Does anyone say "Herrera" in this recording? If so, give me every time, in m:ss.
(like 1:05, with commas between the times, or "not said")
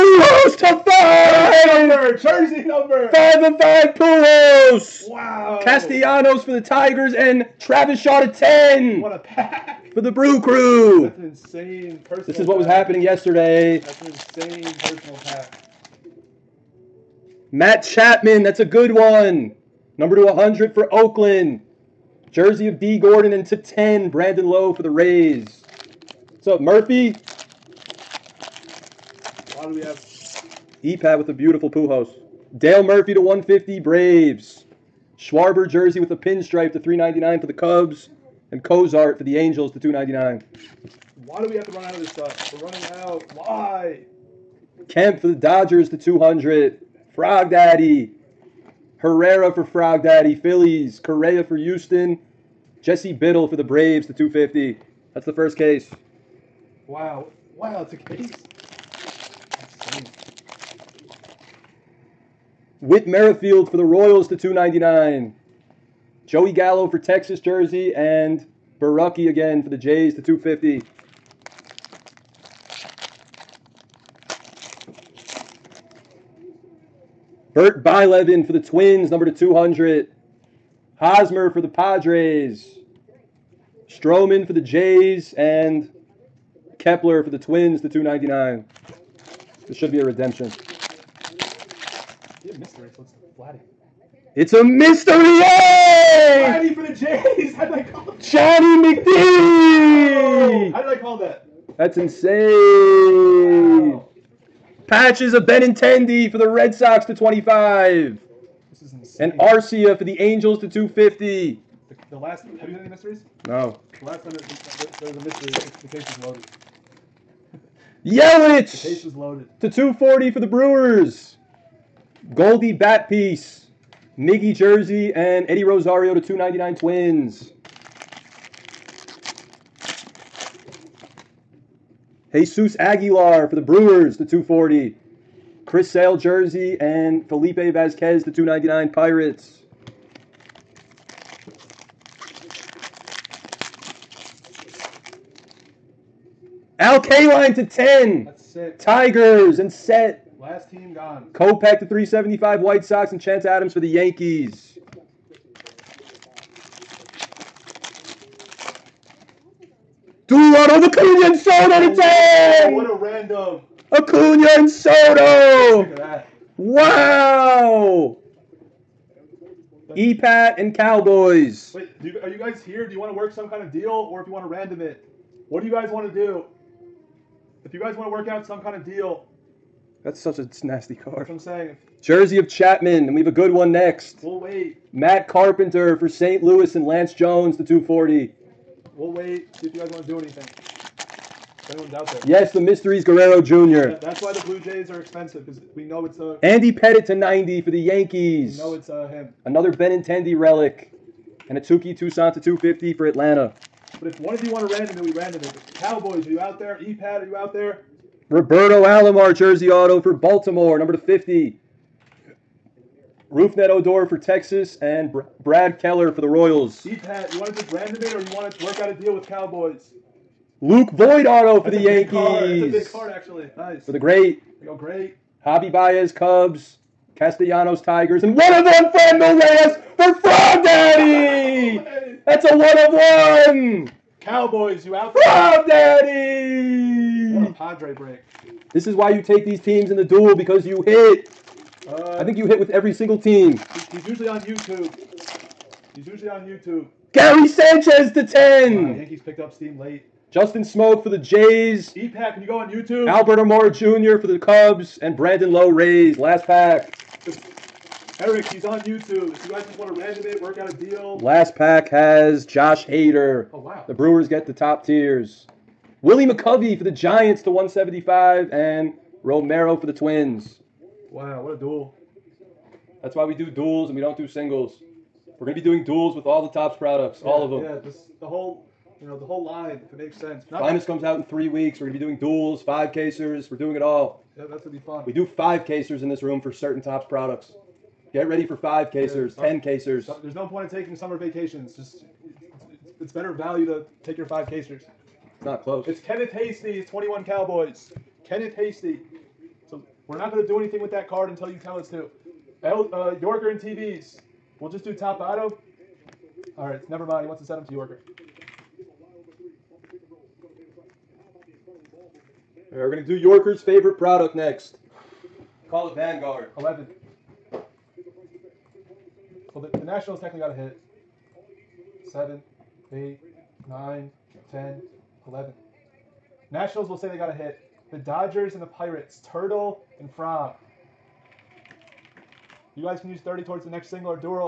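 0:49.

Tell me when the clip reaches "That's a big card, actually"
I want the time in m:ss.
3:42.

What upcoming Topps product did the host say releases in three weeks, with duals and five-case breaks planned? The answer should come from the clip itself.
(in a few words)
Finest.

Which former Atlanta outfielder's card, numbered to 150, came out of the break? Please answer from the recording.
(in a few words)
Dale Murphy.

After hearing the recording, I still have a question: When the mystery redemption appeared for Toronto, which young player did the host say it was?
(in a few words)
Vladdy.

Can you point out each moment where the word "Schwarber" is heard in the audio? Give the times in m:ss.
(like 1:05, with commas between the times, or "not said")
0:35.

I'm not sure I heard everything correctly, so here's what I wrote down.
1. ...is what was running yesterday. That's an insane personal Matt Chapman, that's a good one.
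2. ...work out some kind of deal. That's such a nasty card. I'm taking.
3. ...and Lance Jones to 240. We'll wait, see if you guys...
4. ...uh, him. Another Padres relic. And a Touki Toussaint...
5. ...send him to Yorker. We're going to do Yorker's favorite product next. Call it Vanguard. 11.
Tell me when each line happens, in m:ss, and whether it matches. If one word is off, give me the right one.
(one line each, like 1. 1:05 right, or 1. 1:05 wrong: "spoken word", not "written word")
1. 0:12 wrong: "happening", not "running"
2. 2:58 wrong: "saying", not "taking"
3. 3:06 right
4. 3:18 wrong: "Benintendi", not "Padres"
5. 5:07 right.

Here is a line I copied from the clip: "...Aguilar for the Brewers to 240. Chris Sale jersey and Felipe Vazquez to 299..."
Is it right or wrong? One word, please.
right.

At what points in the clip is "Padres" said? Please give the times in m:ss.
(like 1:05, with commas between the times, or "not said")
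1:21, 3:57.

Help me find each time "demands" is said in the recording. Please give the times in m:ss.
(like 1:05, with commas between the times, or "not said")
not said.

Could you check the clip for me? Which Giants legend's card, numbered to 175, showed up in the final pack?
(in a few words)
Willie McCovey.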